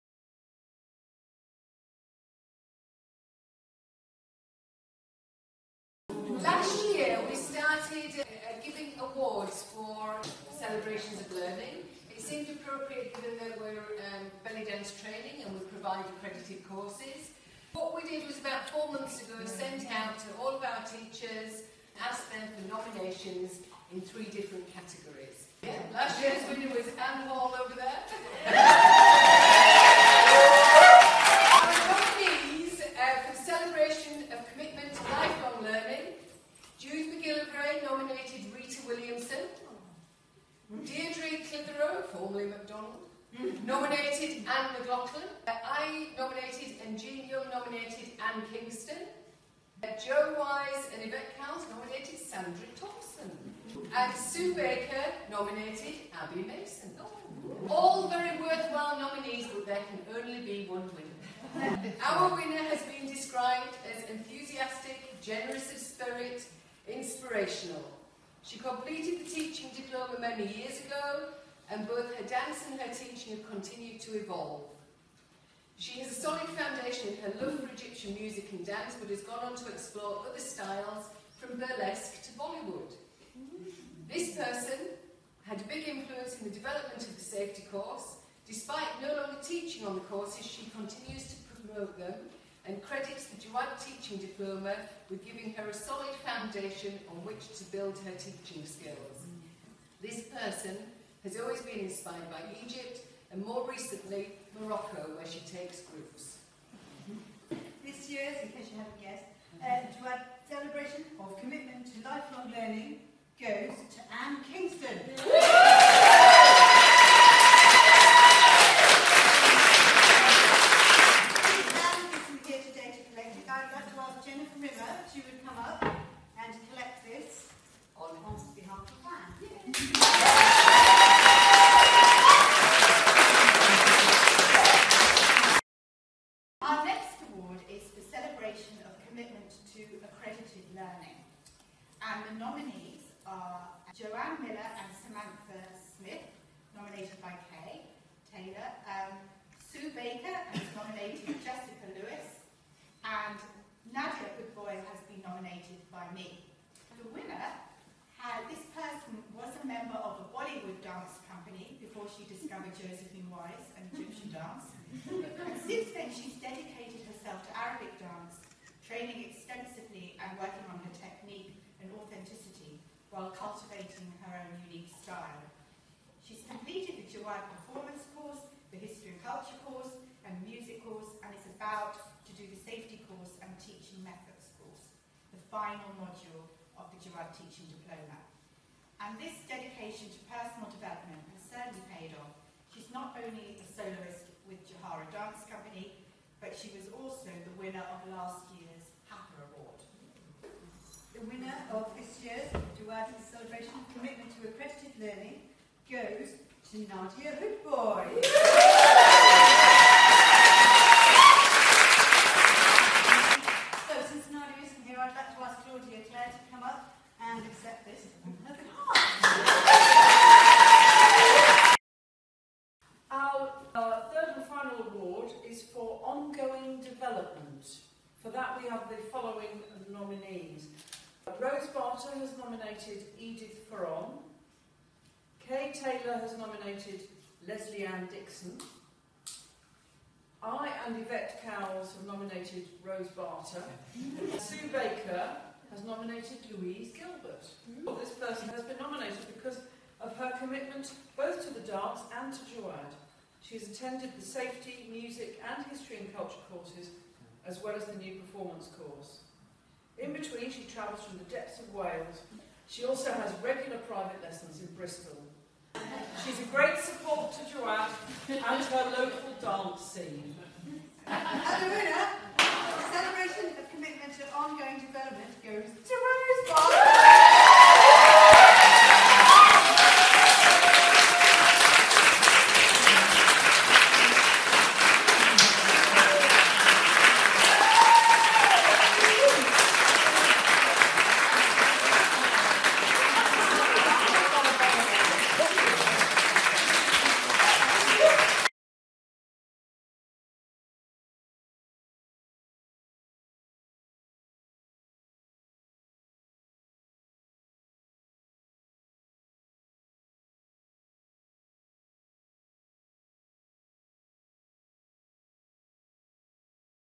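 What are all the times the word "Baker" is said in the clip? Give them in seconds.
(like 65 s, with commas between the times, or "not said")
54 s, 149 s, 244 s.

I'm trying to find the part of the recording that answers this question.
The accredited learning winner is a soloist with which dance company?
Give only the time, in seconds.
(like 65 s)
194 s.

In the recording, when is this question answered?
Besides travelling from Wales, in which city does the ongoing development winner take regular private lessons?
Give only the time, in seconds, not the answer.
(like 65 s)
264 s.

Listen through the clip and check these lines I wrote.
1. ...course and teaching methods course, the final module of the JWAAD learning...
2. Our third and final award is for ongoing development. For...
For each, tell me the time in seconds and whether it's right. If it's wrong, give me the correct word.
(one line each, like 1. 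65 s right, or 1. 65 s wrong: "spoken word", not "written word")
1. 183 s wrong: "teaching", not "learning"
2. 223 s right.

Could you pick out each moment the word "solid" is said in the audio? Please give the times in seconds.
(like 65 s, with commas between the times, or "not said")
76 s, 95 s.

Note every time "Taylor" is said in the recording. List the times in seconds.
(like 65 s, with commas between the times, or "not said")
148 s, 235 s.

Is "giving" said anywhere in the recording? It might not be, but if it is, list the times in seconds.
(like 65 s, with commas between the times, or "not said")
8 s, 95 s.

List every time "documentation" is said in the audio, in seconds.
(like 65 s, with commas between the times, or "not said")
not said.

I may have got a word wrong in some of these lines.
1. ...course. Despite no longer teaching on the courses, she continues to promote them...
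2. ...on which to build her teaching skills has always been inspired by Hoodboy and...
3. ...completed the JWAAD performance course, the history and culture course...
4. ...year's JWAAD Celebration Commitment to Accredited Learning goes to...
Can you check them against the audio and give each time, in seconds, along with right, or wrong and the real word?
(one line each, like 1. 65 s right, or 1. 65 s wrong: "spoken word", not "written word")
1. 87 s right
2. 97 s wrong: "Egypt", not "Hoodboy"
3. 176 s right
4. 202 s right.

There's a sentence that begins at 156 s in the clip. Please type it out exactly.
The winner, had, this person was a member of a Bollywood dance company before she discovered Josephine Wise and Egyptian dance.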